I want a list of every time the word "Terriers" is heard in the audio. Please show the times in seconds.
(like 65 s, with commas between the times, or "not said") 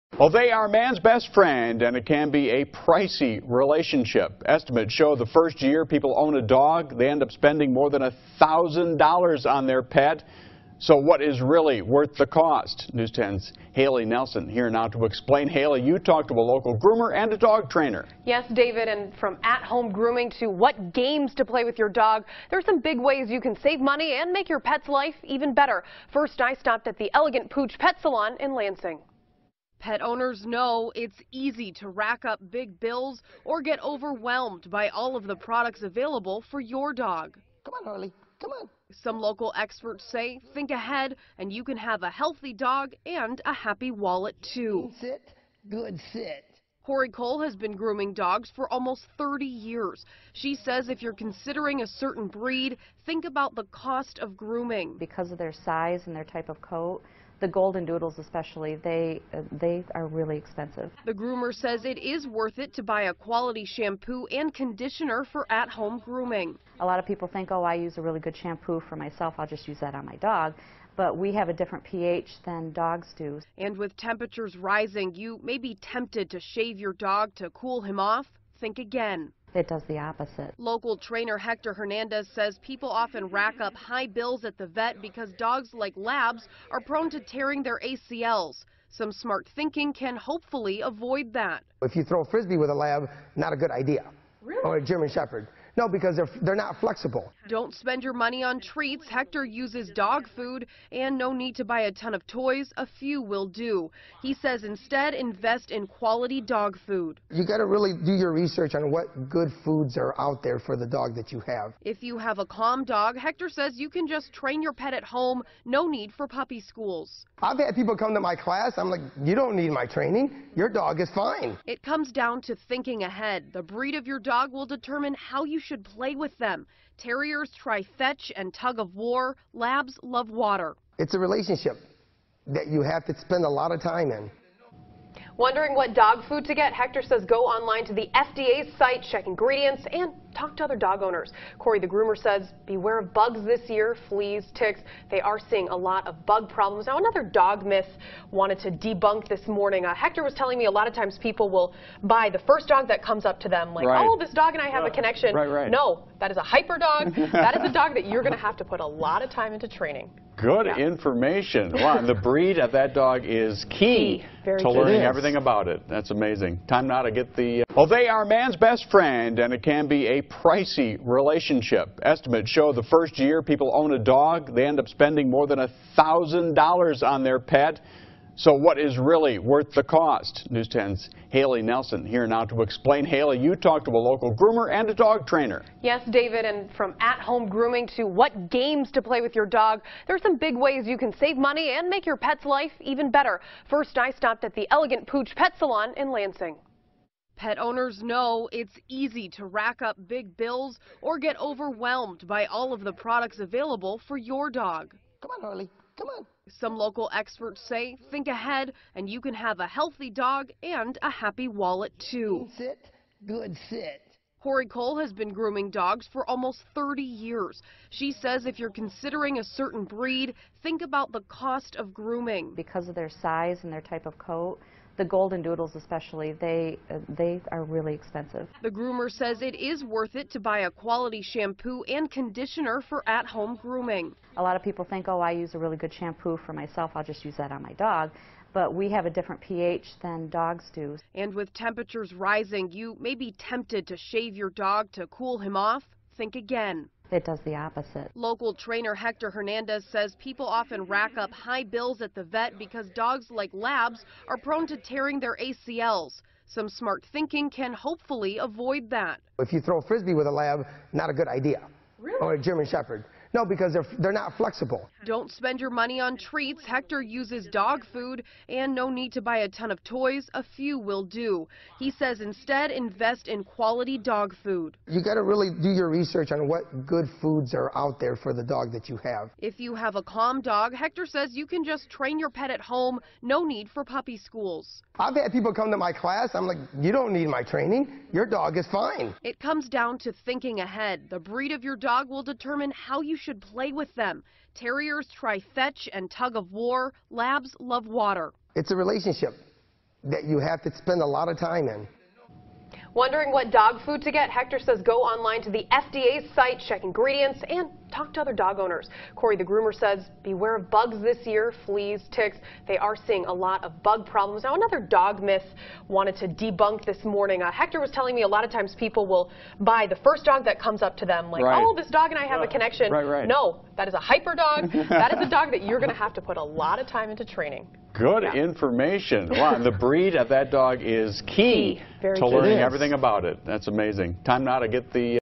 126 s, 294 s.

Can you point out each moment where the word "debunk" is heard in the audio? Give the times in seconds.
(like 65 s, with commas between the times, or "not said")
148 s, 316 s.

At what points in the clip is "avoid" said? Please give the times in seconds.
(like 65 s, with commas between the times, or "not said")
90 s, 258 s.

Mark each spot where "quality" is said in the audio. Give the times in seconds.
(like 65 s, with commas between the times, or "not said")
63 s, 105 s, 230 s, 273 s.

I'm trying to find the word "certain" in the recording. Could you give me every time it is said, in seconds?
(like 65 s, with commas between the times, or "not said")
51 s, 219 s.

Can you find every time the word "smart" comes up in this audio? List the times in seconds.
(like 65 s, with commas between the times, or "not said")
89 s, 256 s.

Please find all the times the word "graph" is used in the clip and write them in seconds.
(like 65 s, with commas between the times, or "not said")
not said.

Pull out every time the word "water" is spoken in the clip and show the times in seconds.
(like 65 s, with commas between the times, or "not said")
130 s, 297 s.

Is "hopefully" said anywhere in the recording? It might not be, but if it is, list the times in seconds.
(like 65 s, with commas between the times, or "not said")
90 s, 257 s.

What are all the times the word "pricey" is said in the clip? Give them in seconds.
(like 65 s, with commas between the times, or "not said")
2 s, 170 s.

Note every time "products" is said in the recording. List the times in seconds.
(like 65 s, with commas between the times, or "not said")
35 s, 202 s.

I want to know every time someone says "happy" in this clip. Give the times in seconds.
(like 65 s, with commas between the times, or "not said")
43 s, 211 s.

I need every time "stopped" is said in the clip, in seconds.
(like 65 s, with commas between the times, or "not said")
26 s, 194 s.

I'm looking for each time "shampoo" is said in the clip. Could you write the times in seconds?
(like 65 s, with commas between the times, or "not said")
63 s, 68 s, 231 s, 235 s.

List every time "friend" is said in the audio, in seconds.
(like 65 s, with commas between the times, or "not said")
1 s, 168 s.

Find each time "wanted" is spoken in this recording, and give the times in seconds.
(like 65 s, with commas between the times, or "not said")
148 s, 315 s.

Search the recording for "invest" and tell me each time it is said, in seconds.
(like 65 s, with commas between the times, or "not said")
105 s, 272 s.